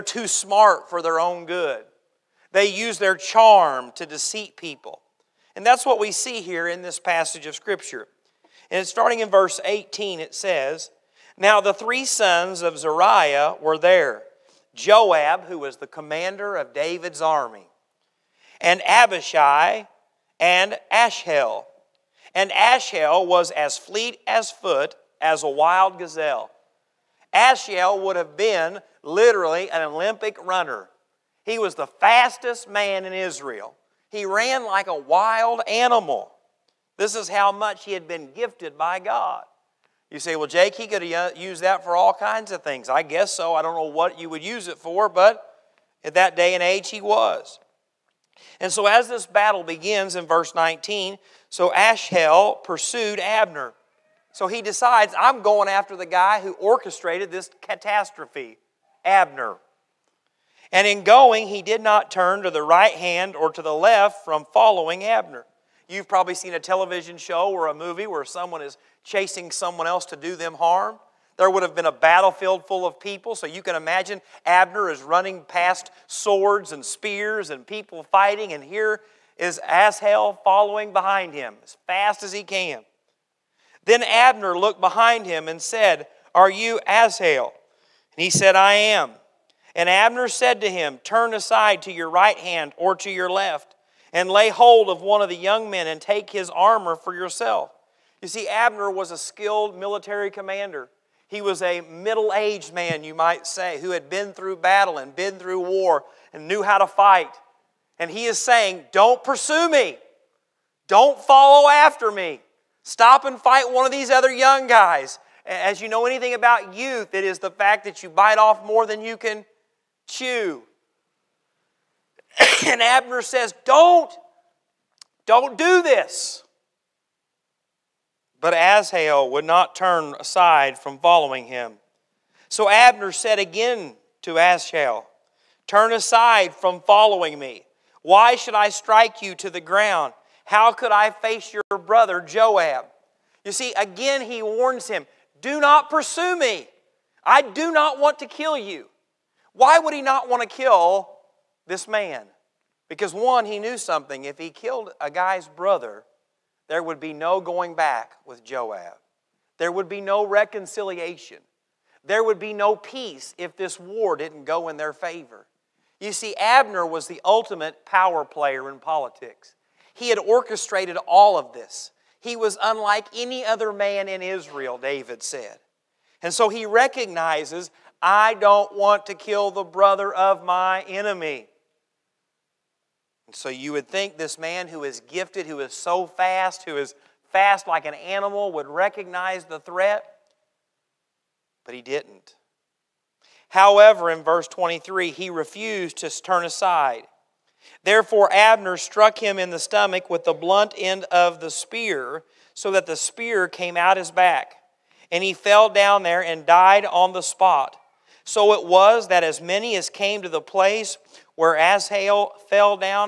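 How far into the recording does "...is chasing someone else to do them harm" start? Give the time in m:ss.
1:08.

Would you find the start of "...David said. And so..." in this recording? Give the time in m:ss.
2:54.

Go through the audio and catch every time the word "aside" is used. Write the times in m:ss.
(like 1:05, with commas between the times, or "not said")
1:31, 2:10, 2:15, 3:16.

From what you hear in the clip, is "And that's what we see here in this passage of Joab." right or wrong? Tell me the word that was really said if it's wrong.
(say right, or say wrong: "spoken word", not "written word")
wrong: "Scripture", not "Joab".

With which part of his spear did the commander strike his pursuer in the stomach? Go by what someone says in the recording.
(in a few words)
The blunt end.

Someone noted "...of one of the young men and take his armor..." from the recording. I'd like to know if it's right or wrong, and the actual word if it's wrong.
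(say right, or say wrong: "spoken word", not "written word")
right.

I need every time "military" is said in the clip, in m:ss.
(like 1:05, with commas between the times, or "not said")
1:39.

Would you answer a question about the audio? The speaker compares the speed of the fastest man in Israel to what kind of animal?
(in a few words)
A wild gazelle.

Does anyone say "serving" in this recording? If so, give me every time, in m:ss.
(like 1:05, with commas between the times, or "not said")
not said.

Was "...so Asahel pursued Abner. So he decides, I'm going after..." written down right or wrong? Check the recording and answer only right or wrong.
right.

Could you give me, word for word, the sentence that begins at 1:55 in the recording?
As you know anything about youth, it is the fact that you bite off more than you can chew.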